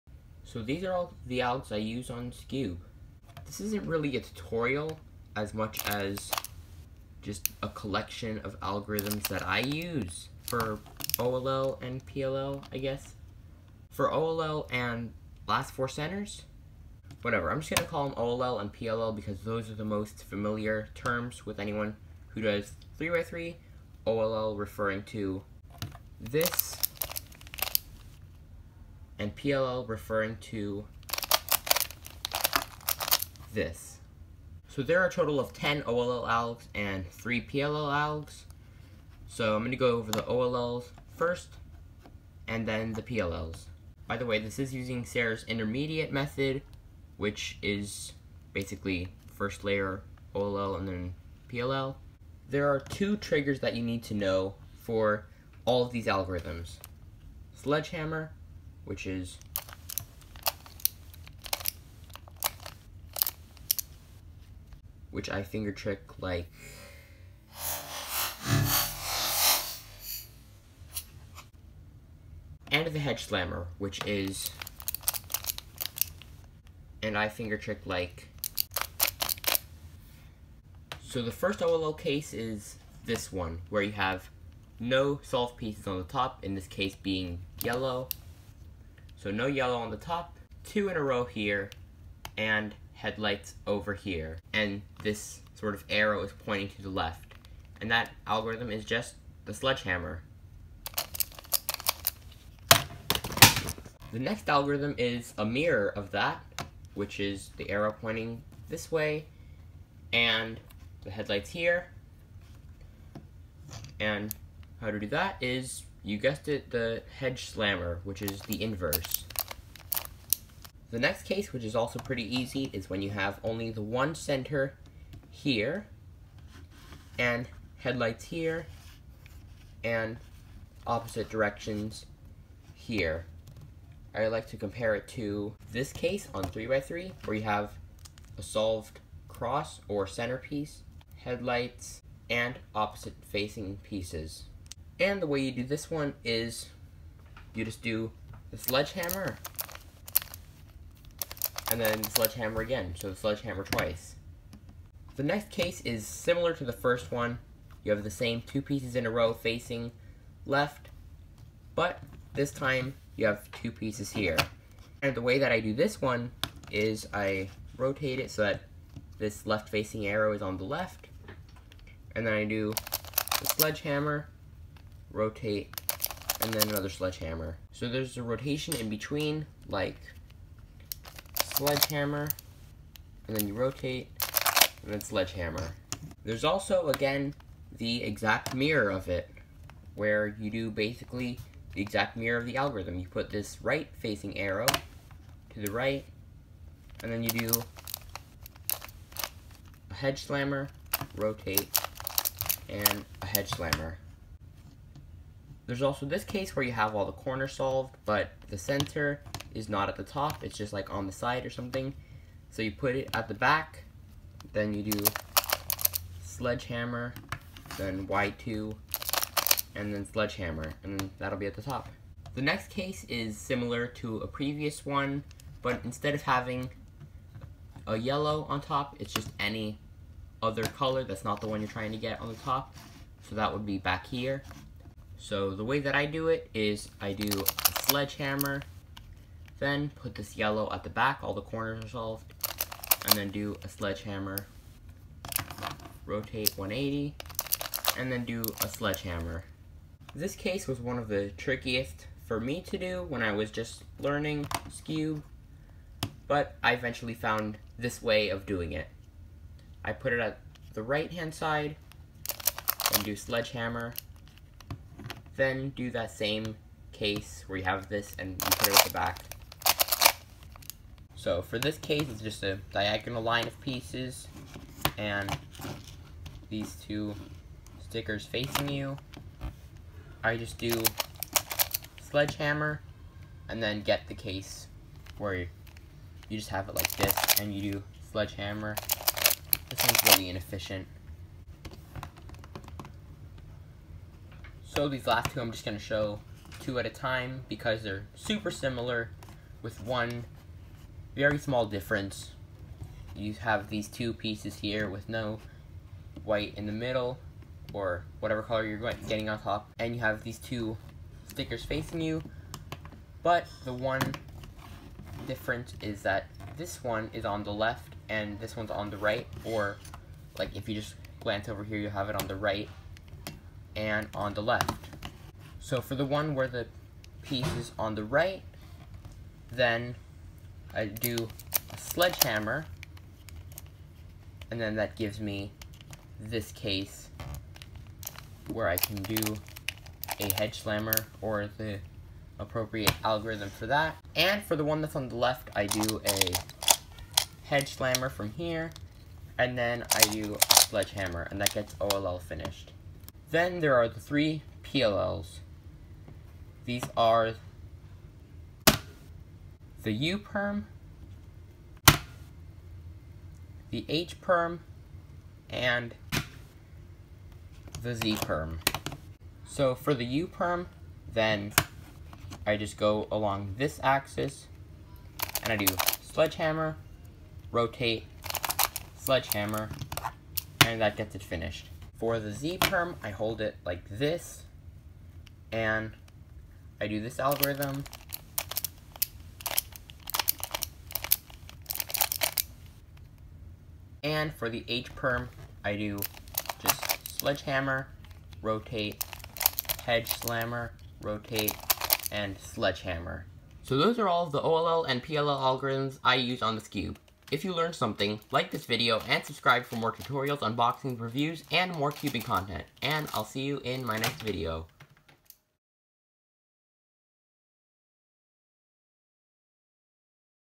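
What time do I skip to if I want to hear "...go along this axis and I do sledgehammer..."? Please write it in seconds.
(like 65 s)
372 s.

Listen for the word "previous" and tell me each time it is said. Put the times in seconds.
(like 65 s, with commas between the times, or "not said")
224 s.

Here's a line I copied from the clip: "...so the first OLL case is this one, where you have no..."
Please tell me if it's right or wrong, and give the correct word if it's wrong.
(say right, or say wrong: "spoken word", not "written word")
right.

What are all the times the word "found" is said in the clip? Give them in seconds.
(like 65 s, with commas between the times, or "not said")
257 s.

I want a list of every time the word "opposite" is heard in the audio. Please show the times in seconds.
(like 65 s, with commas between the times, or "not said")
130 s, 142 s.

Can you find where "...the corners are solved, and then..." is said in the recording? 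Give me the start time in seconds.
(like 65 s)
241 s.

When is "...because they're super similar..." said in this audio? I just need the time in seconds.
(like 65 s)
297 s.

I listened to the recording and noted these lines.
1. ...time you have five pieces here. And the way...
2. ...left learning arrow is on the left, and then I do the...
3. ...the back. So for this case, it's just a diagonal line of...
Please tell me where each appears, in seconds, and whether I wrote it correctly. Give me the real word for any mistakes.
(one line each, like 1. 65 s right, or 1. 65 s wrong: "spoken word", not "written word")
1. 162 s wrong: "two", not "five"
2. 169 s wrong: "facing", not "learning"
3. 268 s right.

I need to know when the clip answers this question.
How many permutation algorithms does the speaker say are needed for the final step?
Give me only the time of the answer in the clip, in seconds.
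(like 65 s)
37 s.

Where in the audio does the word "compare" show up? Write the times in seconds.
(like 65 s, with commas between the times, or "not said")
134 s.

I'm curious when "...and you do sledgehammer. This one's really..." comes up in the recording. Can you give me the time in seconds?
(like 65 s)
287 s.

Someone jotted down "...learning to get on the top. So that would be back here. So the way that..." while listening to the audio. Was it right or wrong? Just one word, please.
wrong.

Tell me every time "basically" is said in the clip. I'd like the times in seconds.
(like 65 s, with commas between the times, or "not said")
48 s, 190 s.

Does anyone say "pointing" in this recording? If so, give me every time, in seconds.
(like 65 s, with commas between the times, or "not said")
96 s, 107 s.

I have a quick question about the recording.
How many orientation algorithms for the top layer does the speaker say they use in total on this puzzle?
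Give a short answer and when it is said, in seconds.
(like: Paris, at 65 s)
10, at 35 s.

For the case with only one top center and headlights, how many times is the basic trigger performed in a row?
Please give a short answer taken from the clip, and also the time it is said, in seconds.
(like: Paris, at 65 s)
twice, at 153 s.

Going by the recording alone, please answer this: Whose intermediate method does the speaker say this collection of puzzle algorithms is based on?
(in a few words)
Sarah's.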